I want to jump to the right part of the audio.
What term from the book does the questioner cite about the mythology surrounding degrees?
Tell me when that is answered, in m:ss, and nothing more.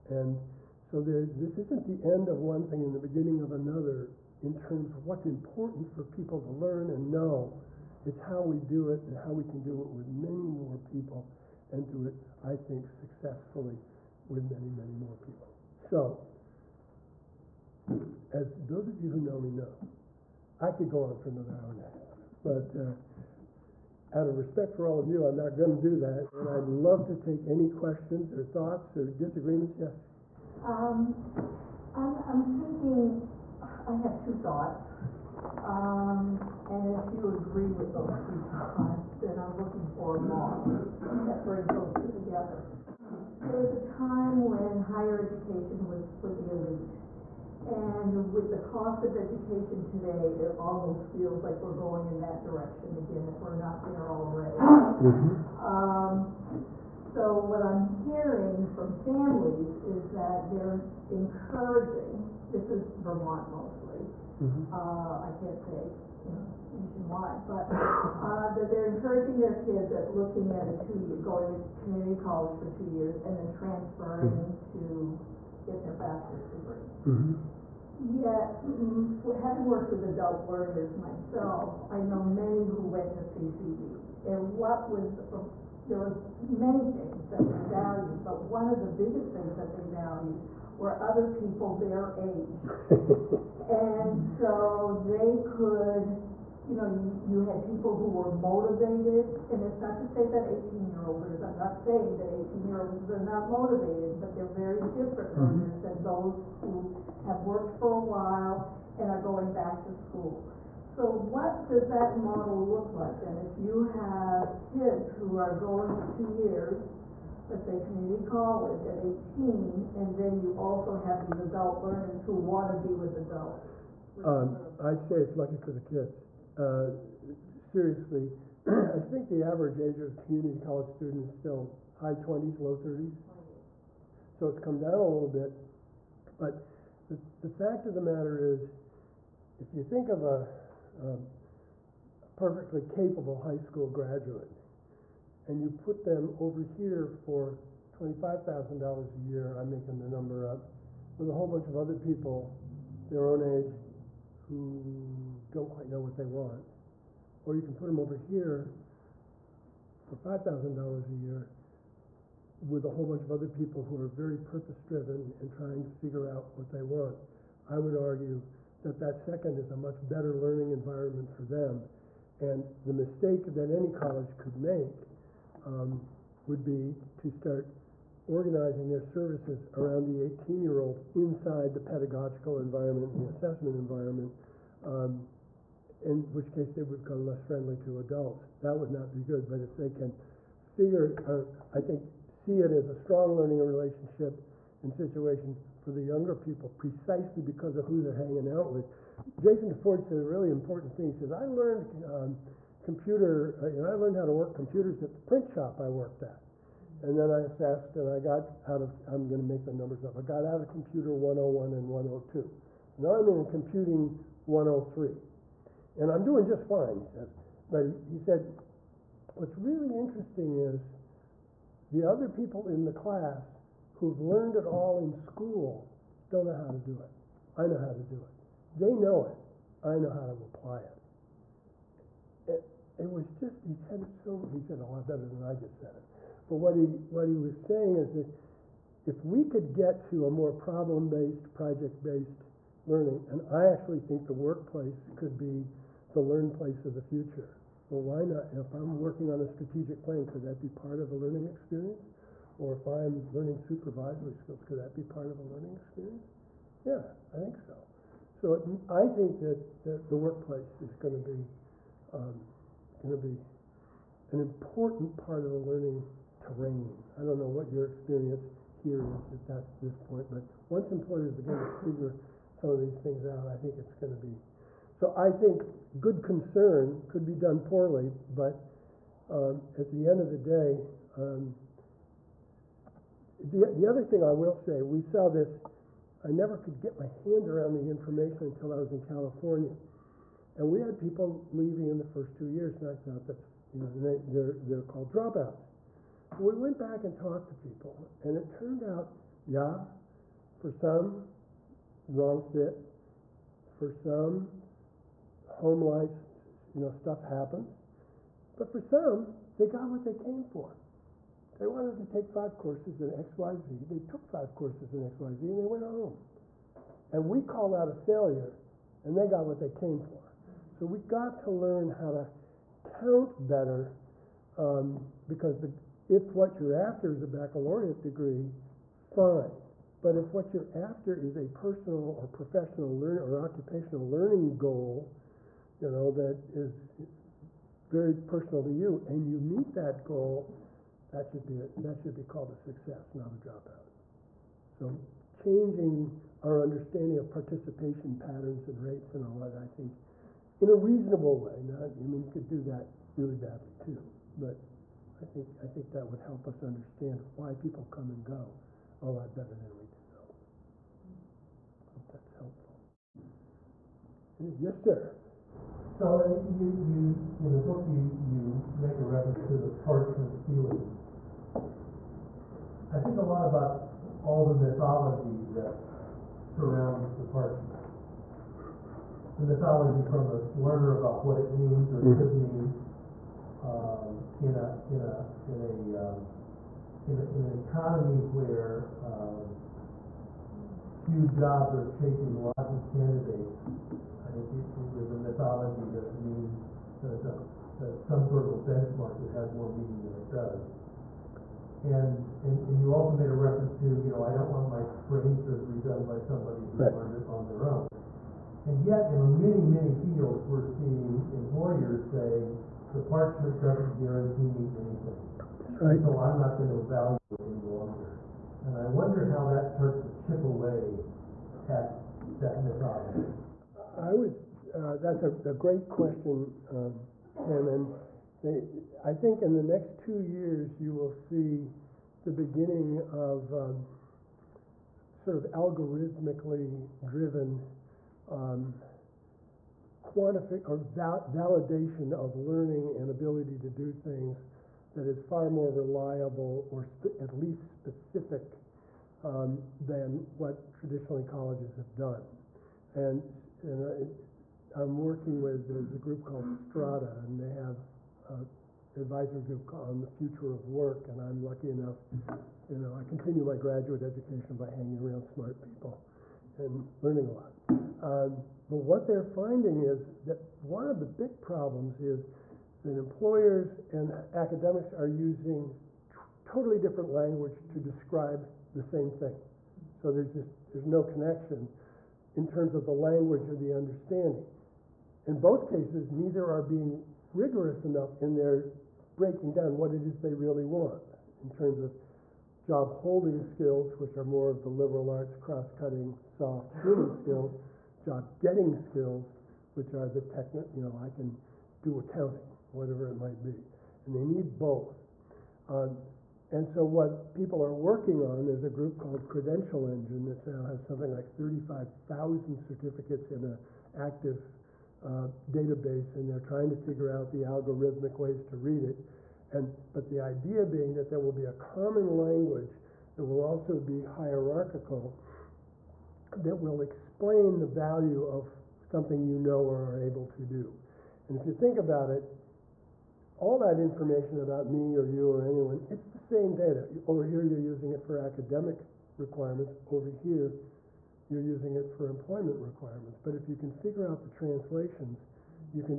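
6:09.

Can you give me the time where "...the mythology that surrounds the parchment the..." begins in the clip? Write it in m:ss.
6:14.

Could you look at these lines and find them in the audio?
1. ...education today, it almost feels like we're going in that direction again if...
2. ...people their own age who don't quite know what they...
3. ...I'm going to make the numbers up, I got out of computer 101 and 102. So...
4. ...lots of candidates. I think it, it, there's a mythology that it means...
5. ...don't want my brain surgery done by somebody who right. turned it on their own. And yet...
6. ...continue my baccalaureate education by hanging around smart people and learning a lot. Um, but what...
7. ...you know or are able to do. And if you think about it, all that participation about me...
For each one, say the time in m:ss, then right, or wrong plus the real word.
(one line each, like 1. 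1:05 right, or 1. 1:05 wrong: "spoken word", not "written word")
1. 0:49 right
2. 2:31 right
3. 3:29 right
4. 6:32 right
5. 6:44 wrong: "learned", not "turned"
6. 7:43 wrong: "graduate", not "baccalaureate"
7. 8:49 wrong: "information", not "participation".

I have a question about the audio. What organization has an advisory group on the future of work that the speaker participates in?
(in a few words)
Strada.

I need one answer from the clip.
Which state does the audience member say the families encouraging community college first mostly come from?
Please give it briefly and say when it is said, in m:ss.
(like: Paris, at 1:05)
Vermont, at 1:02.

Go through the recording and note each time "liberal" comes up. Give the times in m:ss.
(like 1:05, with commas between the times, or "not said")
8:14.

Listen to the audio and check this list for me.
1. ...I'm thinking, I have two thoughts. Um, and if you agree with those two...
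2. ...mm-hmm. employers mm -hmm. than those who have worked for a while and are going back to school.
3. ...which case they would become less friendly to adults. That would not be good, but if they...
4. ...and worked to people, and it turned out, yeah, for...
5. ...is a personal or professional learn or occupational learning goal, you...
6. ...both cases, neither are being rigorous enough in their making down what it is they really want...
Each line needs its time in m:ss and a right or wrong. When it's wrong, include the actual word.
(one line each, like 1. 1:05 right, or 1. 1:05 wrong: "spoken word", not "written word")
1. 0:32 right
2. 1:45 wrong: "learners", not "employers"
3. 3:06 right
4. 4:57 wrong: "talked", not "worked"
5. 5:31 right
6. 8:05 wrong: "breaking", not "making".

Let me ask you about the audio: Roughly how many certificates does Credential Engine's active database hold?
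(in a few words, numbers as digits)
35,000.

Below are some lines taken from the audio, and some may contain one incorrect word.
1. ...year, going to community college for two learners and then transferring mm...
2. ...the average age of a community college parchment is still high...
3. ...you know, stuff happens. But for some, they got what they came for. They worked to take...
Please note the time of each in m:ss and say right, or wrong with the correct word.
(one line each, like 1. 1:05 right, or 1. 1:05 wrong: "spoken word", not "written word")
1. 1:11 wrong: "years", not "learners"
2. 2:09 wrong: "student", not "parchment"
3. 5:06 wrong: "wanted", not "worked".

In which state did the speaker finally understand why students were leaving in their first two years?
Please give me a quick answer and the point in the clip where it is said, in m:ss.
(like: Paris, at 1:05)
California, at 4:49.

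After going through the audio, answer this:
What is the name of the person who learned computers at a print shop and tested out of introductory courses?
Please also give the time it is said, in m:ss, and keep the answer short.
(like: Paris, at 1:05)
Jason DeFord, at 3:19.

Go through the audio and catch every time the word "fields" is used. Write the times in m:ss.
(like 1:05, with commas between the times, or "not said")
6:49.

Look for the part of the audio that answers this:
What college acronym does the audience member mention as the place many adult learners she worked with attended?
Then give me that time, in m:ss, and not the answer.
1:23.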